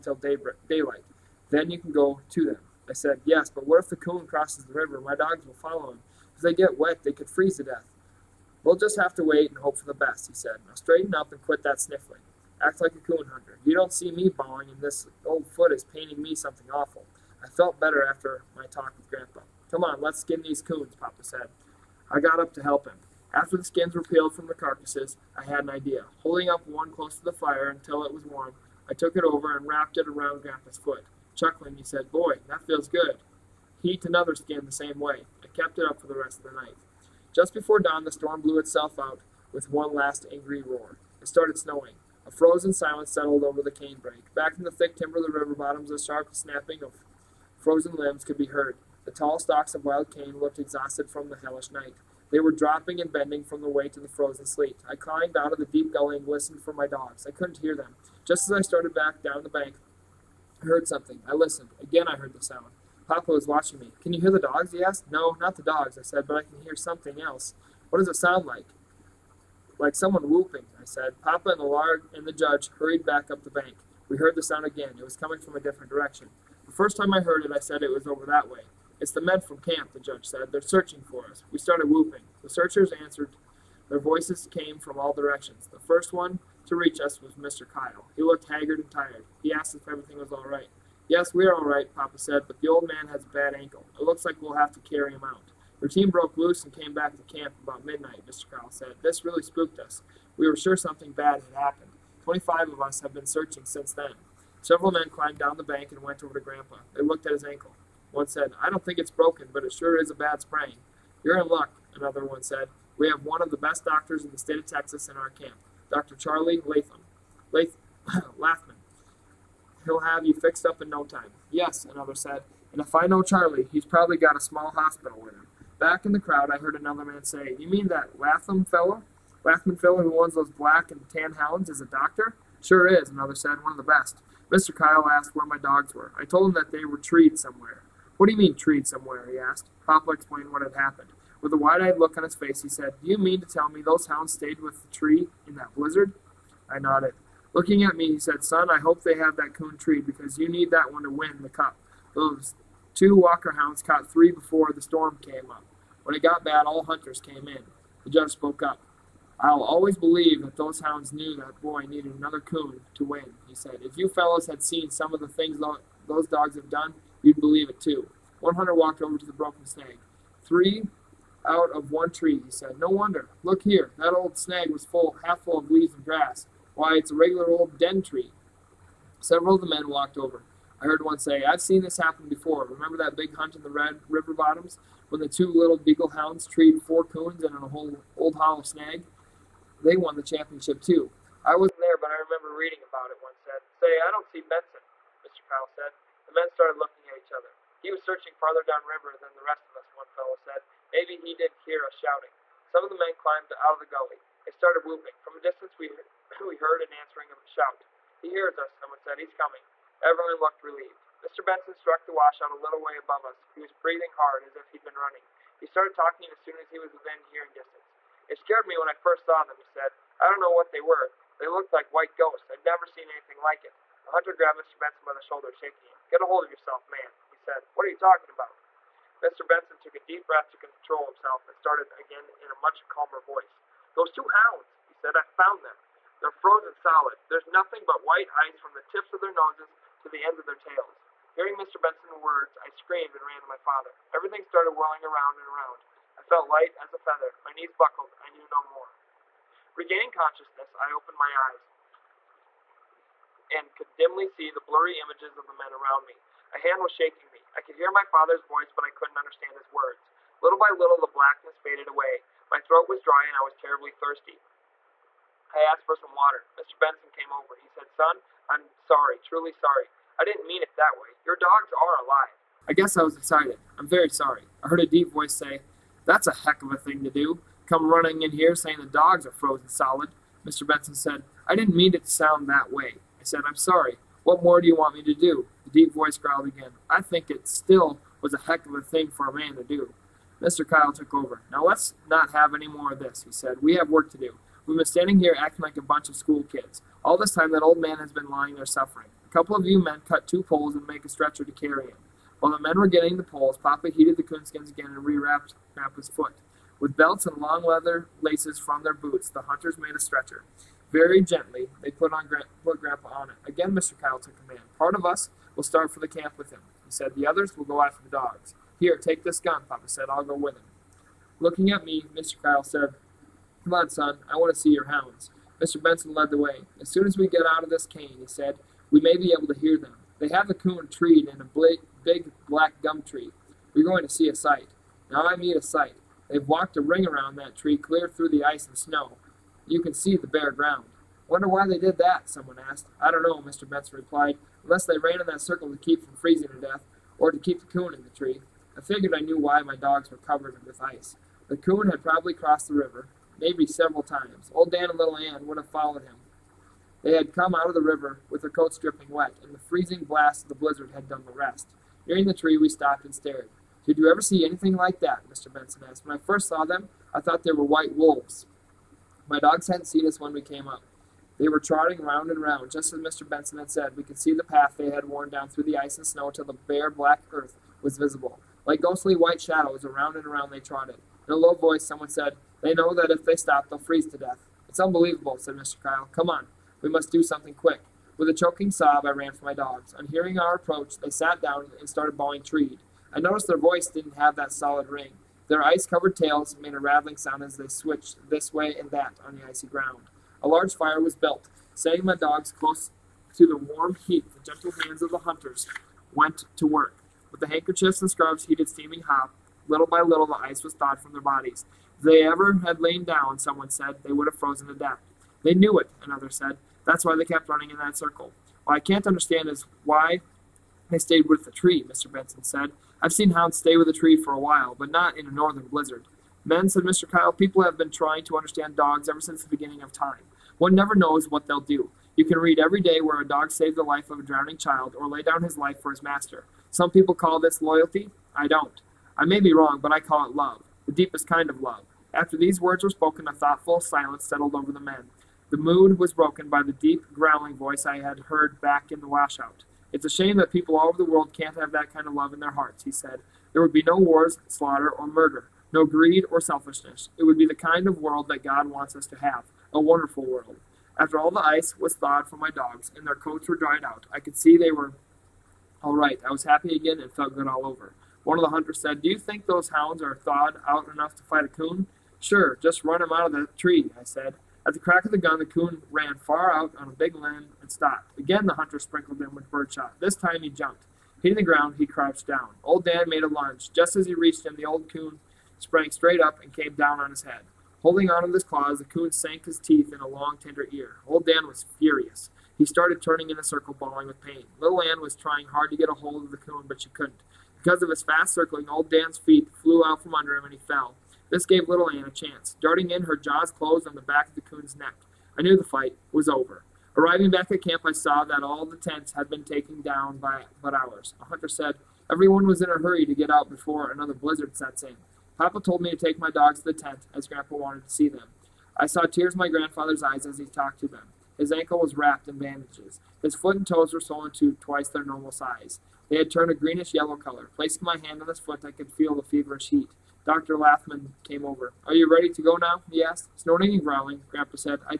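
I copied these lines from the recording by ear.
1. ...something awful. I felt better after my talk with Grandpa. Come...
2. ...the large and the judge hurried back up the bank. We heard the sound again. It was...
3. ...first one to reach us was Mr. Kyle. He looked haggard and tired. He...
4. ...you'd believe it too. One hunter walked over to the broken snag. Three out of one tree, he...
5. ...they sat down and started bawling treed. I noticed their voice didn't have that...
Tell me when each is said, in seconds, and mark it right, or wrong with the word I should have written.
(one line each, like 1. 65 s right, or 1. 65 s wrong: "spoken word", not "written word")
1. 16 s right
2. 71 s right
3. 85 s right
4. 167 s right
5. 390 s right.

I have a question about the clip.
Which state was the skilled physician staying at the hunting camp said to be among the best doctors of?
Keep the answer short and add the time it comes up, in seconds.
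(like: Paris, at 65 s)
Texas, at 114 s.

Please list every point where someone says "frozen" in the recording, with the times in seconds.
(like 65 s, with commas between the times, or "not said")
42 s, 47 s, 54 s, 236 s, 279 s, 414 s.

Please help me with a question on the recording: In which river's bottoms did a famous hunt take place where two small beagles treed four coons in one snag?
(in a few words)
Red River.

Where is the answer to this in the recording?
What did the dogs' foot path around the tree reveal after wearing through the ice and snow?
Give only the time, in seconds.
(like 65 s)
376 s.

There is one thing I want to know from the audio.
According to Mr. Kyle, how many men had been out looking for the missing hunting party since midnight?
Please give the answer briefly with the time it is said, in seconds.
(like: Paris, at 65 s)
25, at 102 s.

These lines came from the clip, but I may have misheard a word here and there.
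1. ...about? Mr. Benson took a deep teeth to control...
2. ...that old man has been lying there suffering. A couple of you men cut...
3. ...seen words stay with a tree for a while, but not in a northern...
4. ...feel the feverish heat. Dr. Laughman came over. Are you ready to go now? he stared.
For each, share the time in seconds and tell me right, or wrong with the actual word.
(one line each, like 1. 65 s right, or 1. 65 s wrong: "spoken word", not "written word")
1. 228 s wrong: "breath", not "teeth"
2. 297 s right
3. 423 s wrong: "hounds", not "words"
4. 528 s wrong: "asked", not "stared".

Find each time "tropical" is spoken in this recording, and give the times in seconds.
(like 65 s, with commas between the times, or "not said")
not said.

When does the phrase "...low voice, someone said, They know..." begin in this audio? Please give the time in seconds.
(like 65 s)
381 s.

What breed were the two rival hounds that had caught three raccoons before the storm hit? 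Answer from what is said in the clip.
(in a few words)
Walker hounds.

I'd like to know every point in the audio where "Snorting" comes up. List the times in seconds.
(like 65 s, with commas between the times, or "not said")
533 s.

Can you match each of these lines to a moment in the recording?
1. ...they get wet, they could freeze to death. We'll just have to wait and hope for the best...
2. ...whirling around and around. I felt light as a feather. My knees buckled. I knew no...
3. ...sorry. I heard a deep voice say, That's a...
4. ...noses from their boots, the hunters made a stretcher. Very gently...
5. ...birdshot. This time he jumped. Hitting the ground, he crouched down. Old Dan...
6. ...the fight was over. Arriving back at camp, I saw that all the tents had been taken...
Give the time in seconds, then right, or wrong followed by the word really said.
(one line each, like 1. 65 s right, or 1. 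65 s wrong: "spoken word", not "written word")
1. 6 s right
2. 244 s right
3. 274 s right
4. 308 s wrong: "laces", not "noses"
5. 479 s right
6. 505 s right.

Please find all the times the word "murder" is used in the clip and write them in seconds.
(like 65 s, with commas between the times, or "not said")
455 s.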